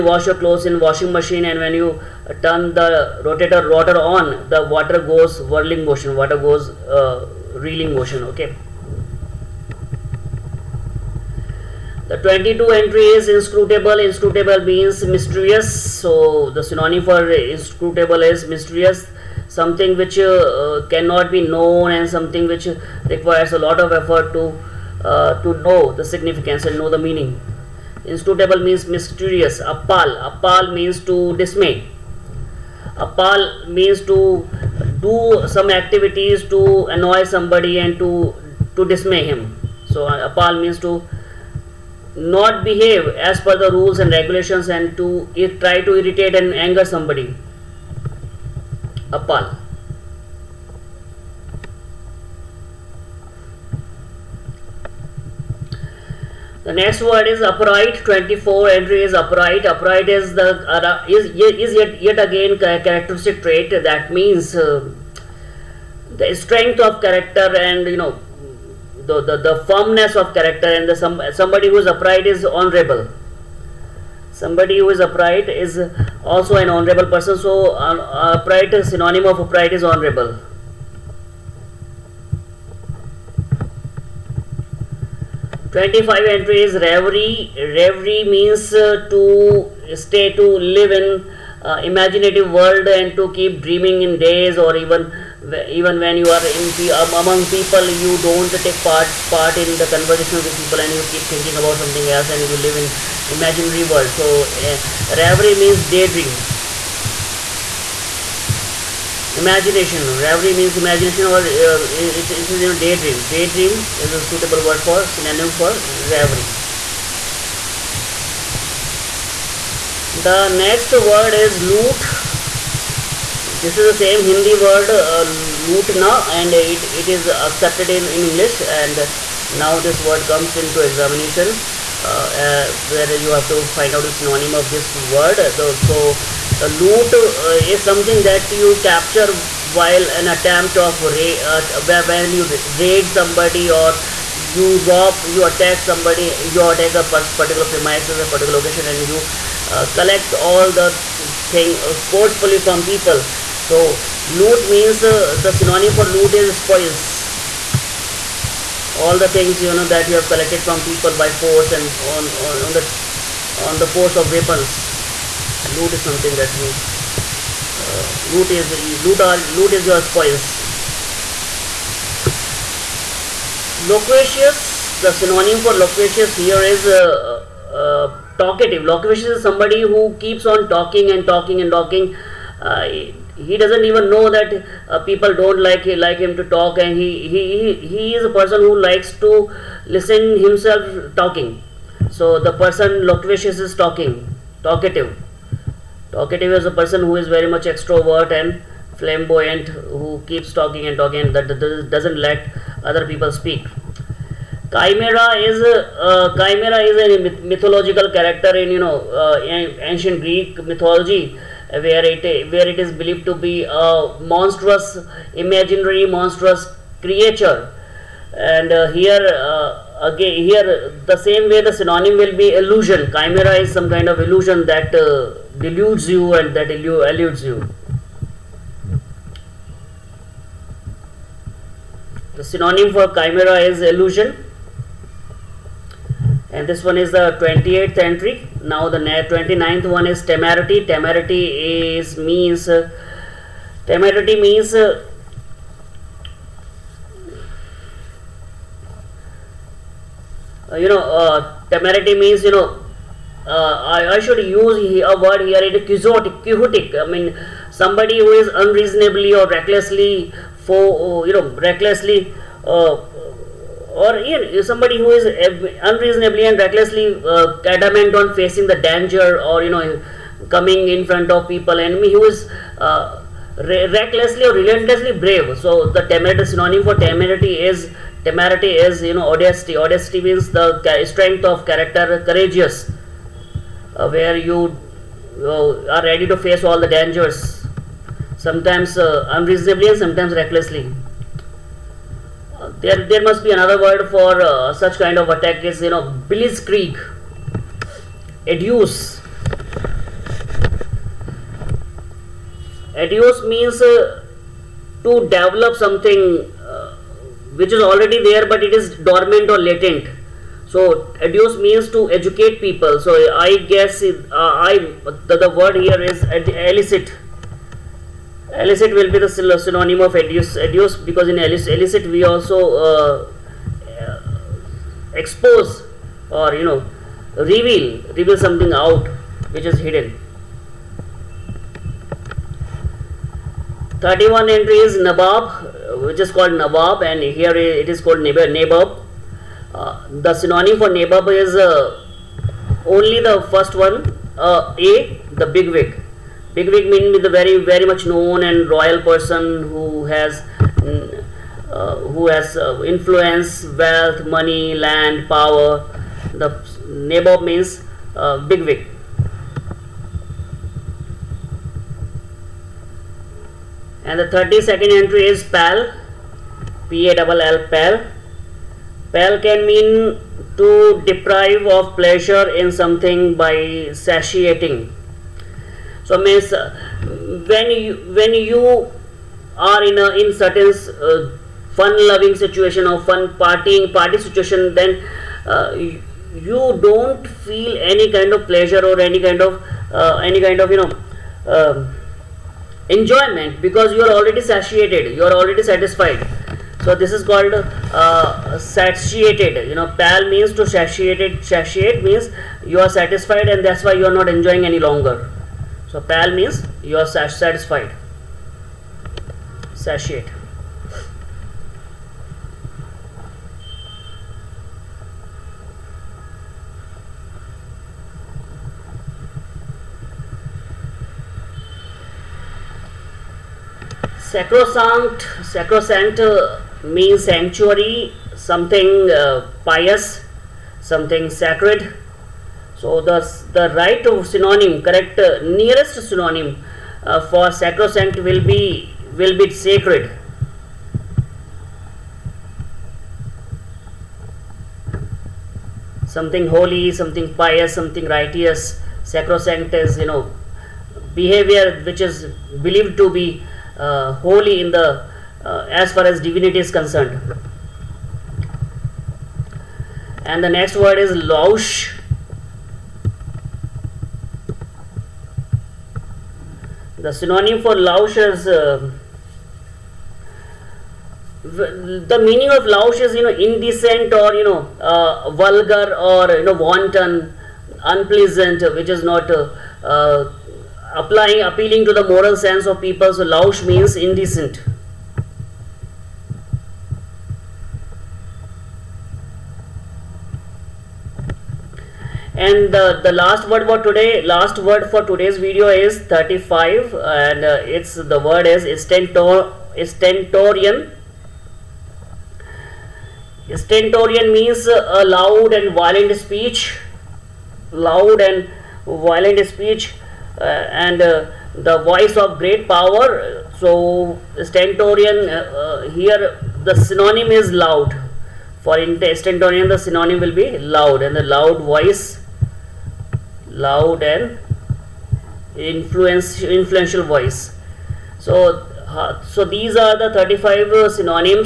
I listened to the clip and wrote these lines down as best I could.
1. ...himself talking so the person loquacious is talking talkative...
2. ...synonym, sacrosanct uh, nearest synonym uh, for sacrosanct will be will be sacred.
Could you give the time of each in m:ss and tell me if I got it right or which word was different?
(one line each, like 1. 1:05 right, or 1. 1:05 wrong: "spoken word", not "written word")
1. 3:10 right
2. 7:14 wrong: "correct", not "sacrosanct".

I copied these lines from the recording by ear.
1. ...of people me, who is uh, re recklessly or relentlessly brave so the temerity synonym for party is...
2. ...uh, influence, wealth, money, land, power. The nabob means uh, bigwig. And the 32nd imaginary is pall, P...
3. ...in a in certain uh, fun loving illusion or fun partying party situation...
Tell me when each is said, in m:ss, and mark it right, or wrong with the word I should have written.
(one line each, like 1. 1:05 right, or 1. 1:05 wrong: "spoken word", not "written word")
1. 4:31 wrong: "temerity", not "party"
2. 5:52 wrong: "entry", not "imaginary"
3. 6:19 wrong: "situation", not "illusion".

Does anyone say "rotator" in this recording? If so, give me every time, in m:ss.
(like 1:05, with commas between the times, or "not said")
0:03.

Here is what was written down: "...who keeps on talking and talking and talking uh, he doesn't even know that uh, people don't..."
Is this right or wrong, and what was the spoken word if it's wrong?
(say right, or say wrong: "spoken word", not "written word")
right.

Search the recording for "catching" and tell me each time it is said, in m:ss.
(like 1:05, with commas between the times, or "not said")
not said.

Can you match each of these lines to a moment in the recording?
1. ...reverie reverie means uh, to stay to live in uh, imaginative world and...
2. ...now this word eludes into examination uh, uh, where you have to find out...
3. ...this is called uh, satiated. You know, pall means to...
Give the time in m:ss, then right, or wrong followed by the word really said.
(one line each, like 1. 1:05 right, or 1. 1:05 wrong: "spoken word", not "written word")
1. 1:26 right
2. 2:09 wrong: "comes", not "eludes"
3. 6:36 right.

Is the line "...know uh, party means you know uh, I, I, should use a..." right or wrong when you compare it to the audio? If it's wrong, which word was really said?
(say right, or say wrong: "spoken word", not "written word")
wrong: "temerity", not "party".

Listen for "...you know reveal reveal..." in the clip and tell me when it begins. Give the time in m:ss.
5:26.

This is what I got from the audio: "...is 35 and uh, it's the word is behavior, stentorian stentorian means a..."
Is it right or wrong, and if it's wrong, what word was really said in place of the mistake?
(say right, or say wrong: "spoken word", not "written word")
wrong: "stentor", not "behavior".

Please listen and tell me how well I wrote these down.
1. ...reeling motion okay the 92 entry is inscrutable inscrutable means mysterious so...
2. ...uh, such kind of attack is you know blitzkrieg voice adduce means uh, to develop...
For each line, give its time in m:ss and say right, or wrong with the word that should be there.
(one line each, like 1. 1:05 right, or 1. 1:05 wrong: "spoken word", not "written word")
1. 0:07 wrong: "22", not "92"
2. 4:54 wrong: "adduce", not "voice".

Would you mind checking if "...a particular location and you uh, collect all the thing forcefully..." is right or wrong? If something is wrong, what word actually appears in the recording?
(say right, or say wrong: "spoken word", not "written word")
right.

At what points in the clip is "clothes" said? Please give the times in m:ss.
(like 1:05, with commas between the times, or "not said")
0:00.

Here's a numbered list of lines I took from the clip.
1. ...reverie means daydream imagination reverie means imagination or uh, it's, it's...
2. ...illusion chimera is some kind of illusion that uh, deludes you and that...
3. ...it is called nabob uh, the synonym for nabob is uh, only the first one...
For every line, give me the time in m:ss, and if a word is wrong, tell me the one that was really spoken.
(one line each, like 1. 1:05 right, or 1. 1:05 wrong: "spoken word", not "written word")
1. 1:45 right
2. 3:42 right
3. 5:37 right.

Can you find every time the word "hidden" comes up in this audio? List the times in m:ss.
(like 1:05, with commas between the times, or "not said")
5:29.